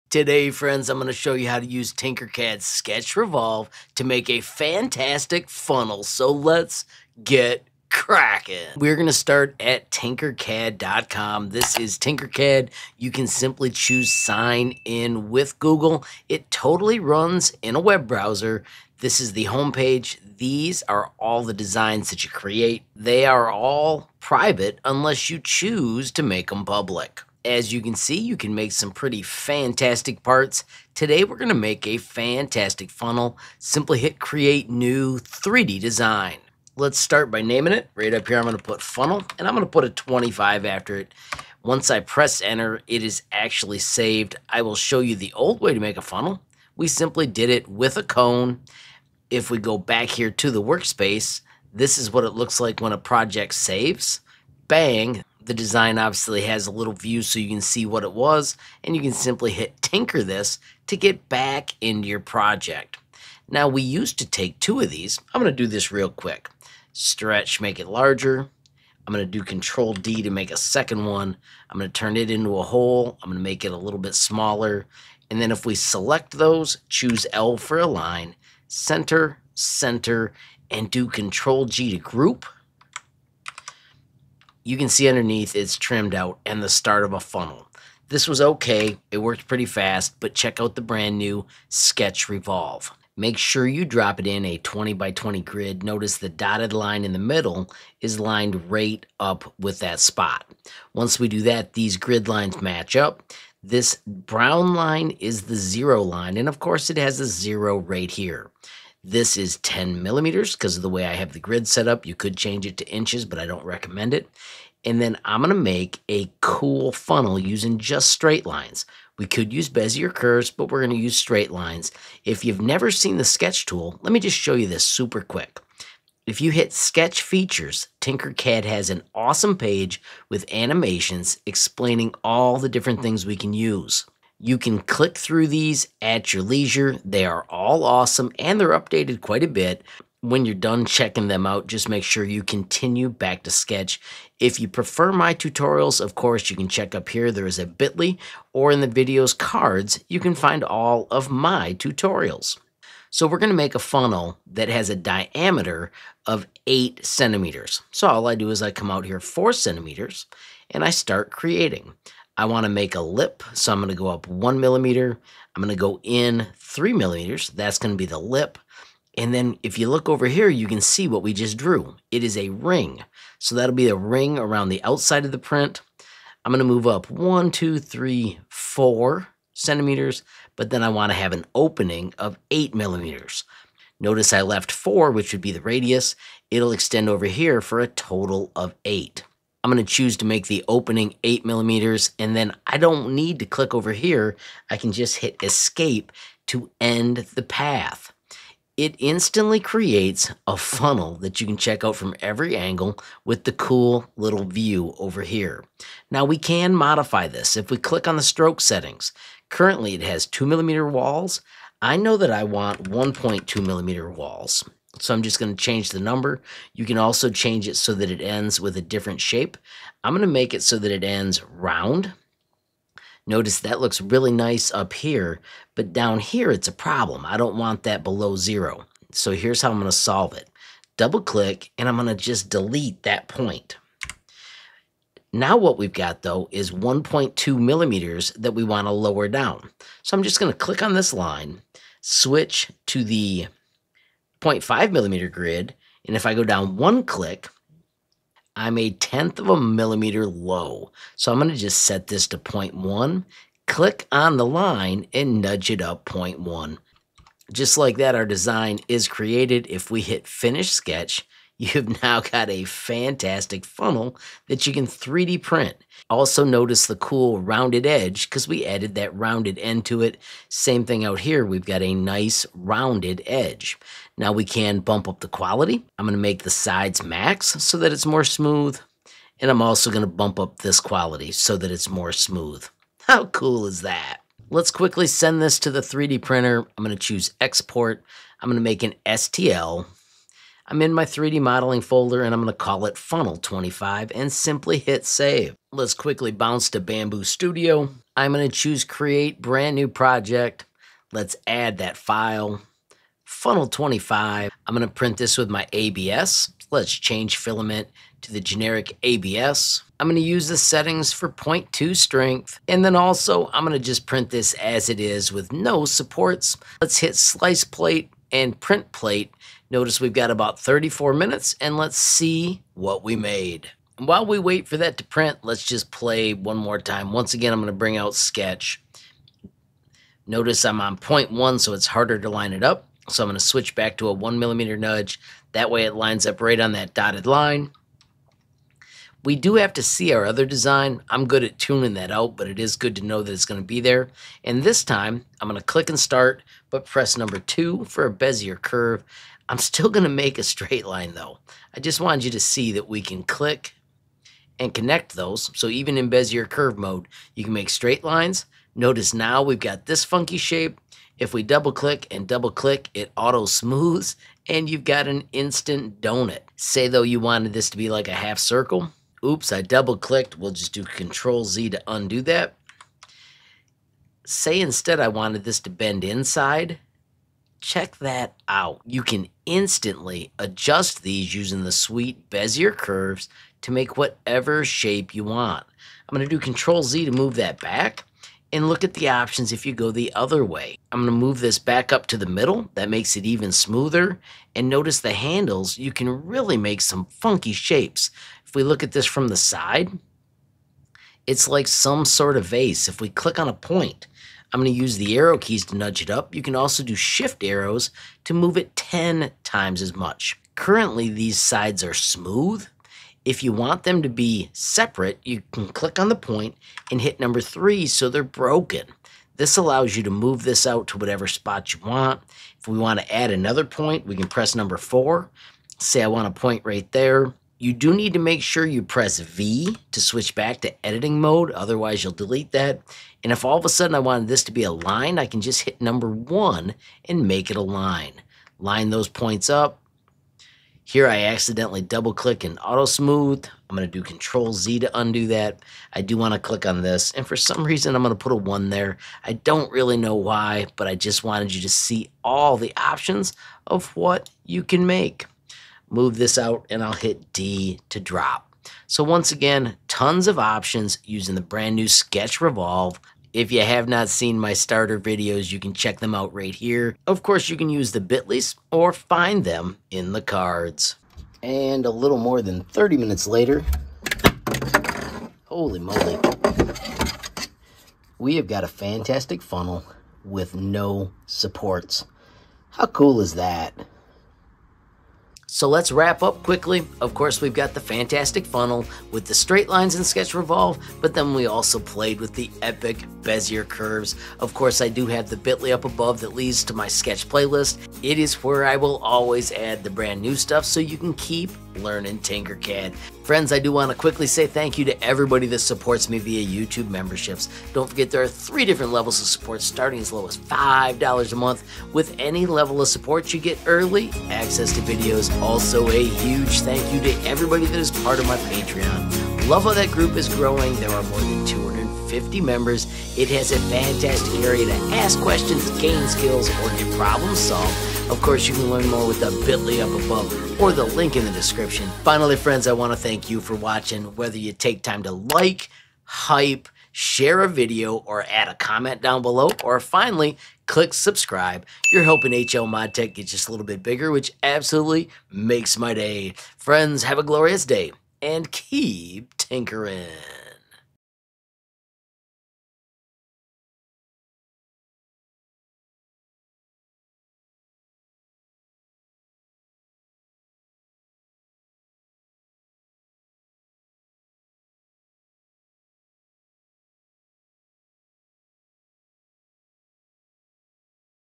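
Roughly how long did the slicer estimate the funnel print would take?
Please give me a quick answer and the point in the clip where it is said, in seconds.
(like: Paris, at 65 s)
34 minutes, at 320 s.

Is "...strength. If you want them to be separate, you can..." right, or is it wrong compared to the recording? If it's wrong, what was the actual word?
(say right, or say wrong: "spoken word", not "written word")
wrong: "smooth", not "strength".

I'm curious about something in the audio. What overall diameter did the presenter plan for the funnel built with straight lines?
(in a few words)
8 centimeters.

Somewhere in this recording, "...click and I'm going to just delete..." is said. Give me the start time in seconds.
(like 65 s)
231 s.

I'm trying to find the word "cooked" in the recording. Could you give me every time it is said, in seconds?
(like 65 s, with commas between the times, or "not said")
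not said.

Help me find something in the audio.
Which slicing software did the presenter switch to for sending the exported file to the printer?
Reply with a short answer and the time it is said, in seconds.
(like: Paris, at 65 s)
Bambu Studio, at 296 s.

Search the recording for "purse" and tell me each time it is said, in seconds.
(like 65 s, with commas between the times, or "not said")
not said.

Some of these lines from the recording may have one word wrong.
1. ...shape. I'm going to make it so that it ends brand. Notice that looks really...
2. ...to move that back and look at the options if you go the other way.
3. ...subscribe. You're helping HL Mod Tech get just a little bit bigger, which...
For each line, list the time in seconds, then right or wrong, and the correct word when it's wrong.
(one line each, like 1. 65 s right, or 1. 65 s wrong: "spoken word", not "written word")
1. 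219 s wrong: "round", not "brand"
2. 387 s right
3. 540 s right.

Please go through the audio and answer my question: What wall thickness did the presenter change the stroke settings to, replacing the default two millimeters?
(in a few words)
1.2 millimeters.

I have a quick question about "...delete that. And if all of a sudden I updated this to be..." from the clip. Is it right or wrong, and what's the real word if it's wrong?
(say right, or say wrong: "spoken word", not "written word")
wrong: "wanted", not "updated".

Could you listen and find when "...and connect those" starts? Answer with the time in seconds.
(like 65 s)
354 s.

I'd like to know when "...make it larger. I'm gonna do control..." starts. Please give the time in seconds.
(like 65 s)
67 s.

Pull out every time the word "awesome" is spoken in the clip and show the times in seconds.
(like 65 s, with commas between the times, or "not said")
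129 s, 137 s.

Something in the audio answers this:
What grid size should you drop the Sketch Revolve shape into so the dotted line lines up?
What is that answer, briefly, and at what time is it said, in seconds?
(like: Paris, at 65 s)
20 by 20, at 94 s.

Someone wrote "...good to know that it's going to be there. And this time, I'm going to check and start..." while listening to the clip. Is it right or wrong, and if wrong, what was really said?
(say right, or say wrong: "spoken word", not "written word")
wrong: "click", not "check".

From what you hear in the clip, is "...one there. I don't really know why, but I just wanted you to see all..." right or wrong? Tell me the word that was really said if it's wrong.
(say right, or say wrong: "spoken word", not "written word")
right.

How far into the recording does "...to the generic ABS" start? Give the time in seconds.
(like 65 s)
308 s.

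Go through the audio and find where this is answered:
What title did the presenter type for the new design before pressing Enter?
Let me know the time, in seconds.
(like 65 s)
38 s.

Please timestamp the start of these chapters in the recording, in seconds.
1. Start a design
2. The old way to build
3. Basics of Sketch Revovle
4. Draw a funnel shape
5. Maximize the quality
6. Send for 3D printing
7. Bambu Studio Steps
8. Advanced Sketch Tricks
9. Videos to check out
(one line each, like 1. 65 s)
1. 33 s
2. 63 s
3. 92 s
4. 152 s
5. 274 s
6. 285 s
7. 299 s
8. 324 s
9. 460 s.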